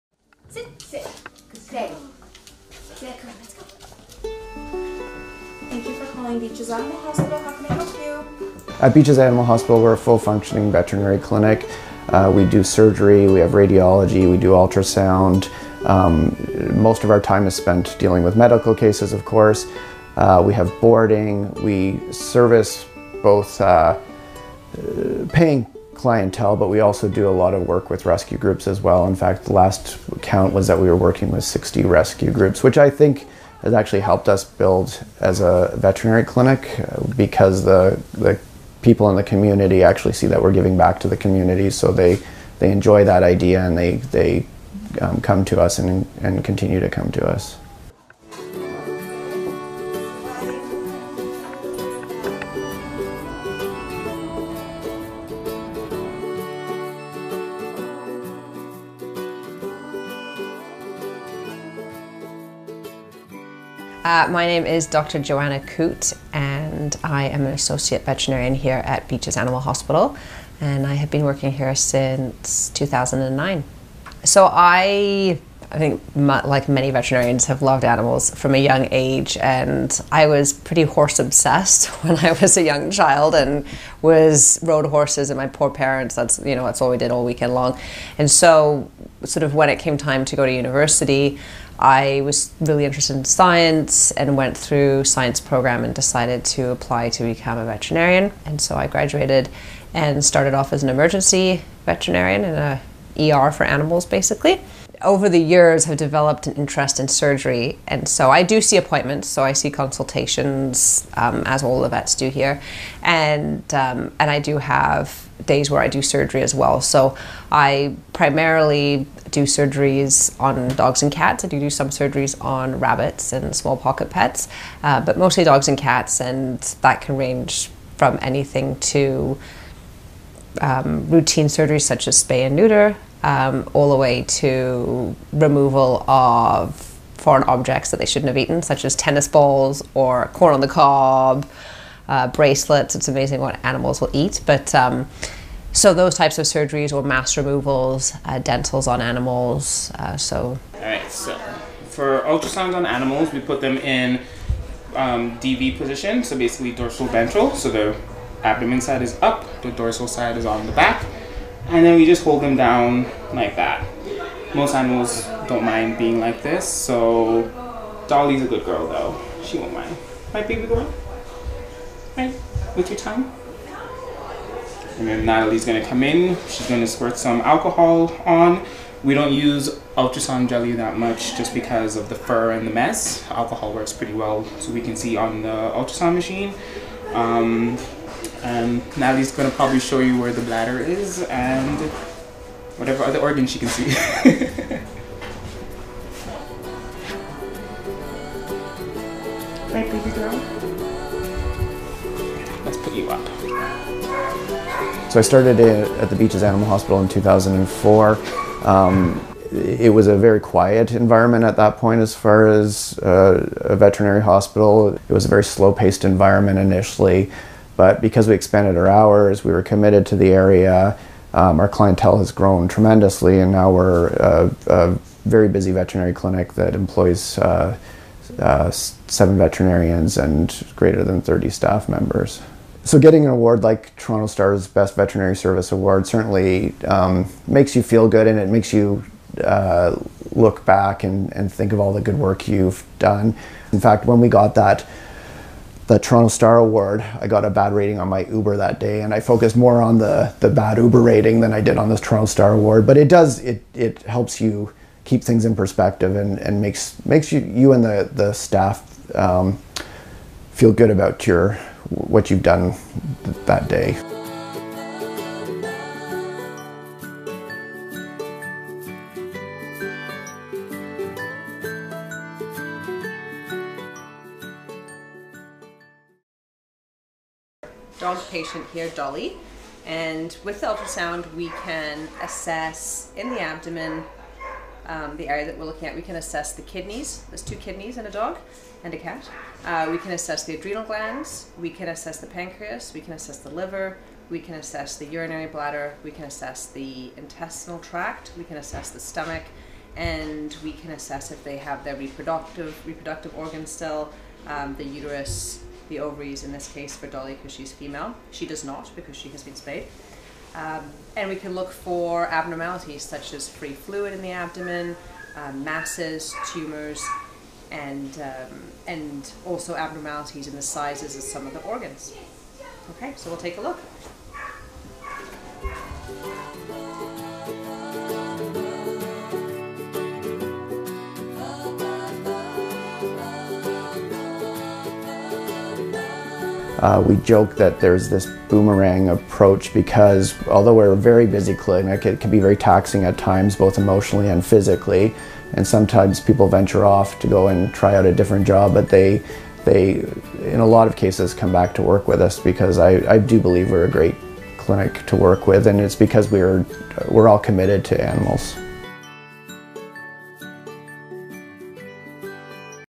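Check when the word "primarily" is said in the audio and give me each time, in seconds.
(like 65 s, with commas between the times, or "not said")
118 s.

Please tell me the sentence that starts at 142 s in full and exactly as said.
It's amazing what animals will eat, but.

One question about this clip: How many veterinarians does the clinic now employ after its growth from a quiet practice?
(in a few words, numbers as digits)
7.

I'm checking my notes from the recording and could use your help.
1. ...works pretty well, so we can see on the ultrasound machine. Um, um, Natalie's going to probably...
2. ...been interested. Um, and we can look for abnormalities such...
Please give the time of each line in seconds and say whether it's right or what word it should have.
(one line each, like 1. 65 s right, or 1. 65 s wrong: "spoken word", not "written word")
1. 183 s right
2. 309 s wrong: "spayed", not "interested".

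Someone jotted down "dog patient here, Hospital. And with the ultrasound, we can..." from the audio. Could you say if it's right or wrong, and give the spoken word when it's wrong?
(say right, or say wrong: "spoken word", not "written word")
wrong: "Dolly", not "Hospital".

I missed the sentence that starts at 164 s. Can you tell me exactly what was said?
Most animals don't mind being like this, so Dolly's a good girl though.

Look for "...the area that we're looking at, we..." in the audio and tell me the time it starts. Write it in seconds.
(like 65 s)
285 s.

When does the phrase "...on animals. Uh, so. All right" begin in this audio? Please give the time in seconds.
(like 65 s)
148 s.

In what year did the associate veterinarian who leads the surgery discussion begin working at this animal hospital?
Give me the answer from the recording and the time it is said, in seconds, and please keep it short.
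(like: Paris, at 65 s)
2009, at 72 s.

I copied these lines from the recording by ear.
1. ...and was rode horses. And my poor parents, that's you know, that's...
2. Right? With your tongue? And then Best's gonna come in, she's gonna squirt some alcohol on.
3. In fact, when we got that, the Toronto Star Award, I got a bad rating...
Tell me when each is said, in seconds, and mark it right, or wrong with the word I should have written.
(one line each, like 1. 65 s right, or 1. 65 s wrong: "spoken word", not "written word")
1. 83 s right
2. 172 s wrong: "Natalie", not "Best"
3. 243 s right.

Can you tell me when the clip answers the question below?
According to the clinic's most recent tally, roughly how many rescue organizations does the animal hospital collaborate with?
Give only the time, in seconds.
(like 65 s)
31 s.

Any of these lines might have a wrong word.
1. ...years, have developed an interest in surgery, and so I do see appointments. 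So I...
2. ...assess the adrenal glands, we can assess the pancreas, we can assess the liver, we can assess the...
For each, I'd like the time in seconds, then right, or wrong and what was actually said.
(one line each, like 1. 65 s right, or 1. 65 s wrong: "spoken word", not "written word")
1. 105 s right
2. 290 s right.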